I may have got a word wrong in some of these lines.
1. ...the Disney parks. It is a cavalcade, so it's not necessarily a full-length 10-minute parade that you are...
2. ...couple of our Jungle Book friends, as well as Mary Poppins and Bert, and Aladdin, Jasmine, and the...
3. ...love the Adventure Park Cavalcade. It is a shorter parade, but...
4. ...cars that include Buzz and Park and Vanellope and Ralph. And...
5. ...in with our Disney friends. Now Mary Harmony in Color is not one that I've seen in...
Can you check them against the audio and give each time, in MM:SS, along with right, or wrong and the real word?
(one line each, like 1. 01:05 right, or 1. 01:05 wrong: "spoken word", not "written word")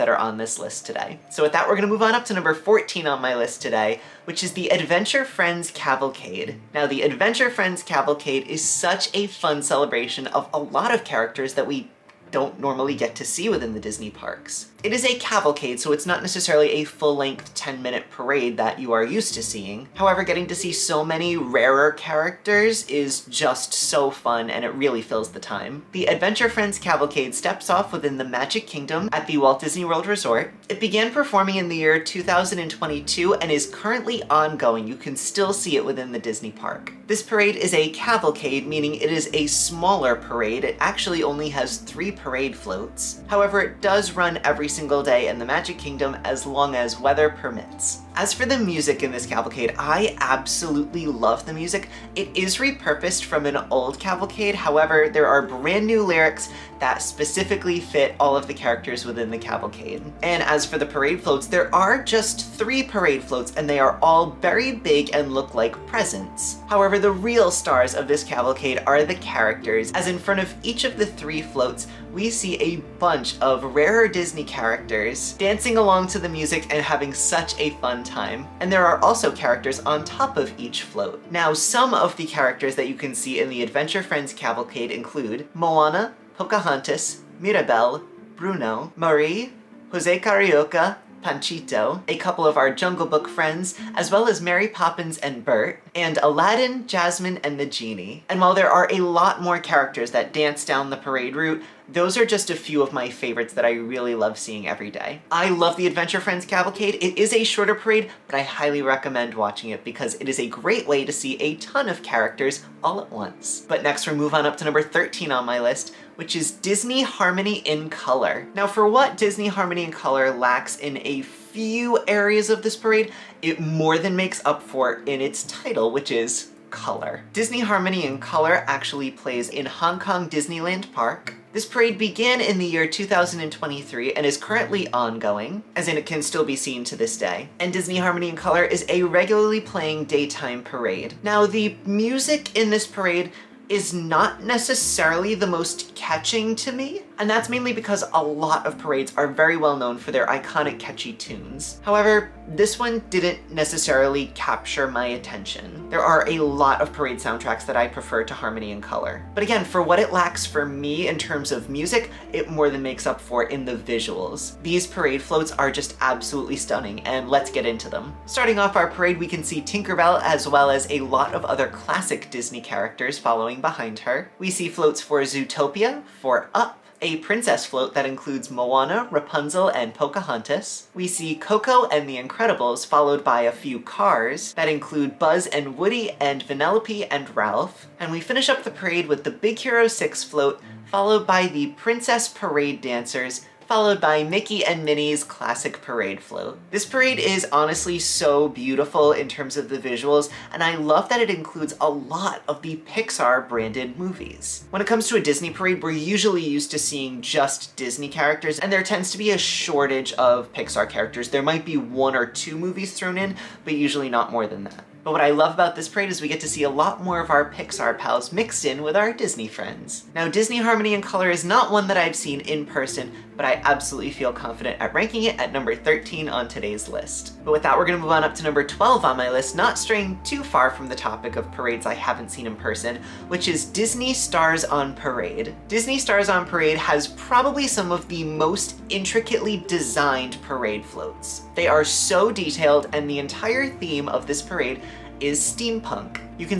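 1. 00:13 right
2. 01:32 right
3. 01:45 wrong: "Friends", not "Park"
4. 03:03 wrong: "Woody", not "Park"
5. 03:38 wrong: "Disney", not "Mary".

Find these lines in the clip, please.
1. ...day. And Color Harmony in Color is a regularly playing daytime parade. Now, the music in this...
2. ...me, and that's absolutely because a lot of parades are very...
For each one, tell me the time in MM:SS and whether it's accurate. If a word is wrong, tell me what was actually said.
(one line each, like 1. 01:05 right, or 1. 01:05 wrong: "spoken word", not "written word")
1. 02:17 wrong: "Disney", not "Color"
2. 02:26 wrong: "mainly", not "absolutely".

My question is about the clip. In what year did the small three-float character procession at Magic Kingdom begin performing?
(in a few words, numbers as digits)
2022.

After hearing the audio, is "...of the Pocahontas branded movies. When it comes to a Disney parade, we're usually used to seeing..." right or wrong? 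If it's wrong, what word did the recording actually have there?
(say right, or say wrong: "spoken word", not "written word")
wrong: "Pixar", not "Pocahontas".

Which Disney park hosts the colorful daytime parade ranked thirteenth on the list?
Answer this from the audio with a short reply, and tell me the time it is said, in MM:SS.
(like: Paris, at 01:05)
Hong Kong Disneyland, at 02:09.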